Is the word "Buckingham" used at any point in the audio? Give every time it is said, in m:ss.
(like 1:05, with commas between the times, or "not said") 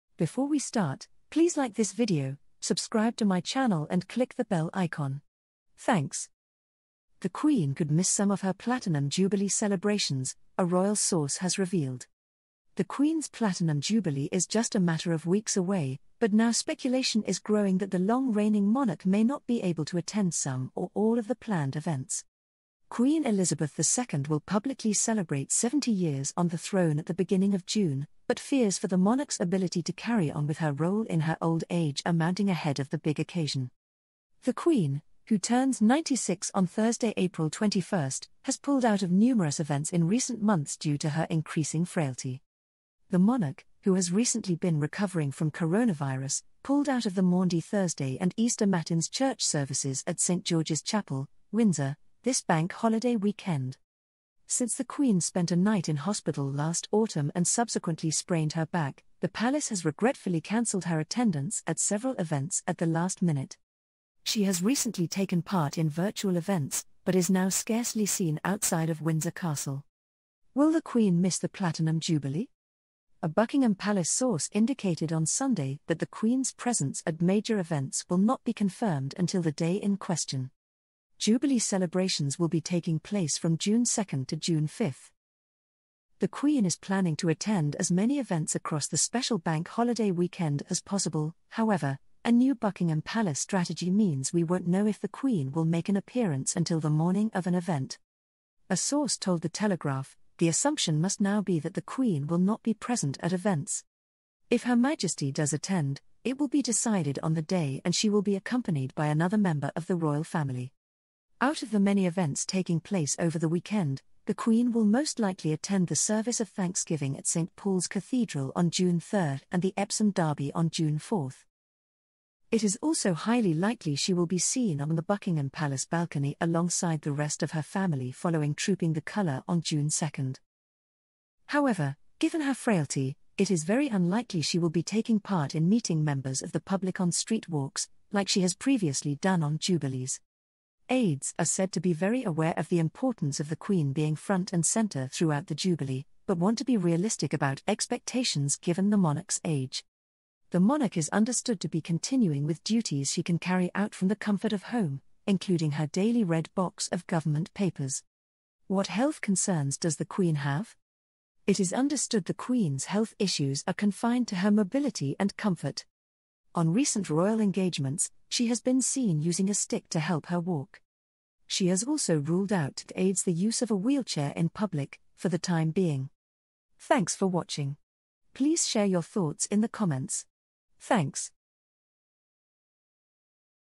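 1:13, 1:32, 2:05.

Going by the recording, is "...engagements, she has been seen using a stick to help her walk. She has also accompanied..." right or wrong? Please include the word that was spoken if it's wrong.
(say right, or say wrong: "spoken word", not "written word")
wrong: "ruled", not "accompanied".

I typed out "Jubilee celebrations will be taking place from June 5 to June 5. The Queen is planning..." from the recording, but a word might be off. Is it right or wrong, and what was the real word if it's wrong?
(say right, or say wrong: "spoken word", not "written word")
wrong: "2", not "5".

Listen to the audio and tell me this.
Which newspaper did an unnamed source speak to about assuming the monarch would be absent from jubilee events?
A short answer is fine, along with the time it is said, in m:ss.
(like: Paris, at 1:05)
The Telegraph, at 1:39.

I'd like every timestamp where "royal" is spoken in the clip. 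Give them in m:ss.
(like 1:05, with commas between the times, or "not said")
0:10, 1:49, 2:47.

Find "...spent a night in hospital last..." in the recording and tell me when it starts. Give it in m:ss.
0:55.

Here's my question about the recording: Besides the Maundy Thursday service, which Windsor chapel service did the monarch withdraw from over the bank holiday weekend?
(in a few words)
Easter Matins.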